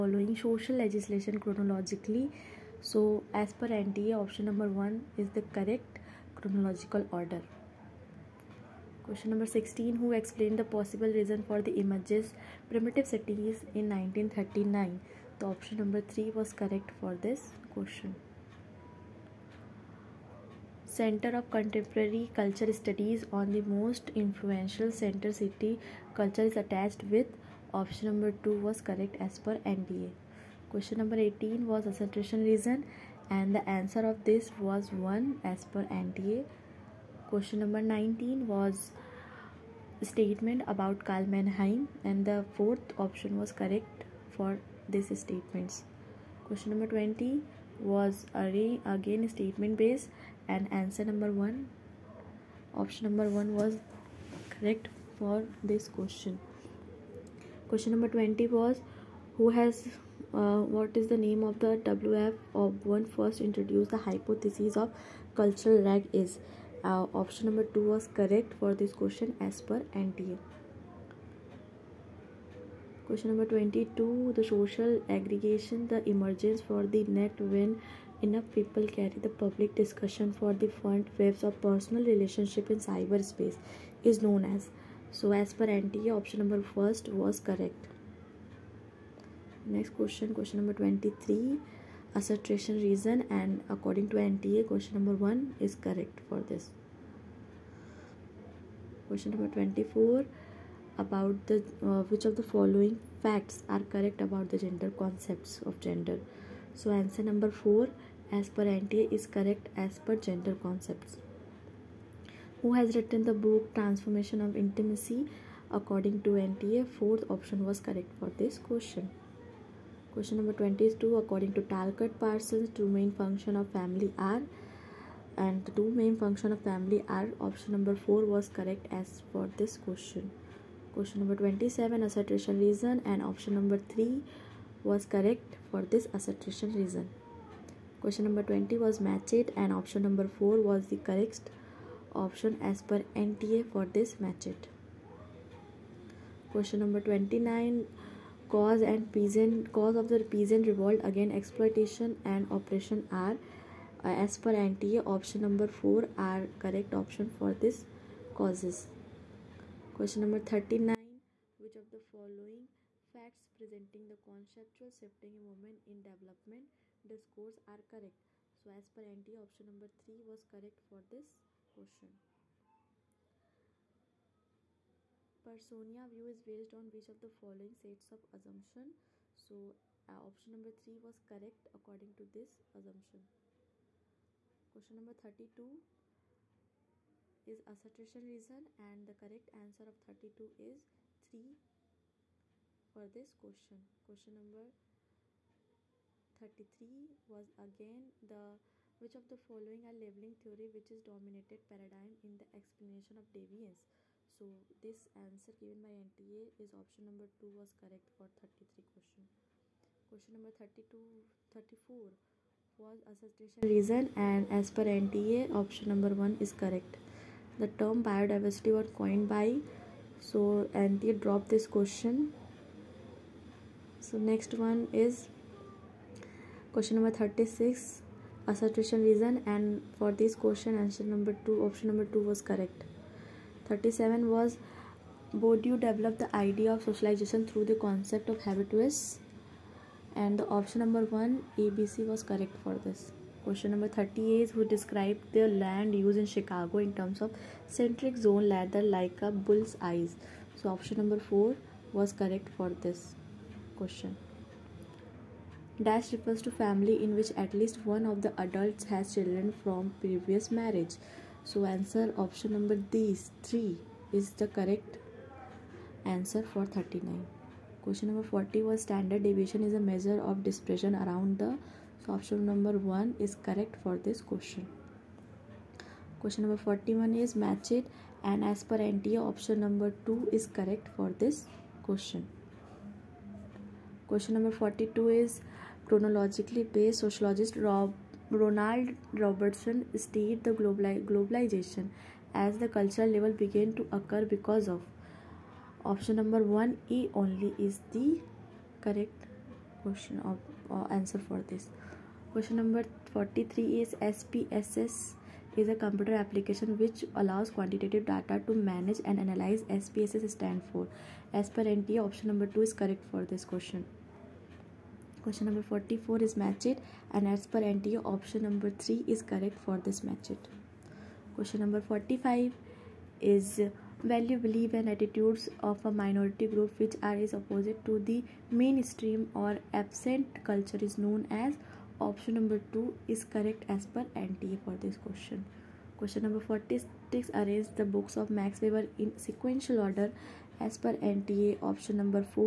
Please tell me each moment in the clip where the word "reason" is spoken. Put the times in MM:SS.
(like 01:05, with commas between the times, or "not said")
00:11, 00:32, 01:32, 02:12, 02:16, 03:08, 03:33, 03:49.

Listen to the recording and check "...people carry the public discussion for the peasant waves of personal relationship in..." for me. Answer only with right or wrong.
wrong.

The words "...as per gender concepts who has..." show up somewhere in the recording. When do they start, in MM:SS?
01:49.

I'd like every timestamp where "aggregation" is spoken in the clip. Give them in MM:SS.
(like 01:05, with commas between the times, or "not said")
01:15.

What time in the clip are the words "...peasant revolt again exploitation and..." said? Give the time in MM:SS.
02:30.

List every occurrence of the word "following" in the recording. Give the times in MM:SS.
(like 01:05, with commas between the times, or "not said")
01:42, 02:41, 02:57, 03:19.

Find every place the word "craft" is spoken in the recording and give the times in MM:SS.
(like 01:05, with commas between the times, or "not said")
not said.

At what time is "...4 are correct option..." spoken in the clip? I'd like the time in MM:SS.
02:35.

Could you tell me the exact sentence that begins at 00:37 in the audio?
Question number 19 was statement about Karl Mannheim and the fourth option was correct for this statements.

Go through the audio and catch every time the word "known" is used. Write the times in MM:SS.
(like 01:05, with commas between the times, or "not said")
01:24, 05:30.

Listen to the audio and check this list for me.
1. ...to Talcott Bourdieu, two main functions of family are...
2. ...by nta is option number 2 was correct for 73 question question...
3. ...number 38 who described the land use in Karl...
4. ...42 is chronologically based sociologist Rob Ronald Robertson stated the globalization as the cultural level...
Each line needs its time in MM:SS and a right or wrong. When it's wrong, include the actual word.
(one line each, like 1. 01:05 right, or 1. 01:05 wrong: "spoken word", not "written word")
1. 02:01 wrong: "Parsons", not "Bourdieu"
2. 03:25 wrong: "33", not "73"
3. 04:03 wrong: "Chicago", not "Karl"
4. 04:44 right.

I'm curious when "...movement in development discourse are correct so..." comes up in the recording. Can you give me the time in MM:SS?
02:45.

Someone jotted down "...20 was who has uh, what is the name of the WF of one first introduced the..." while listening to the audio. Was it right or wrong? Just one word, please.
right.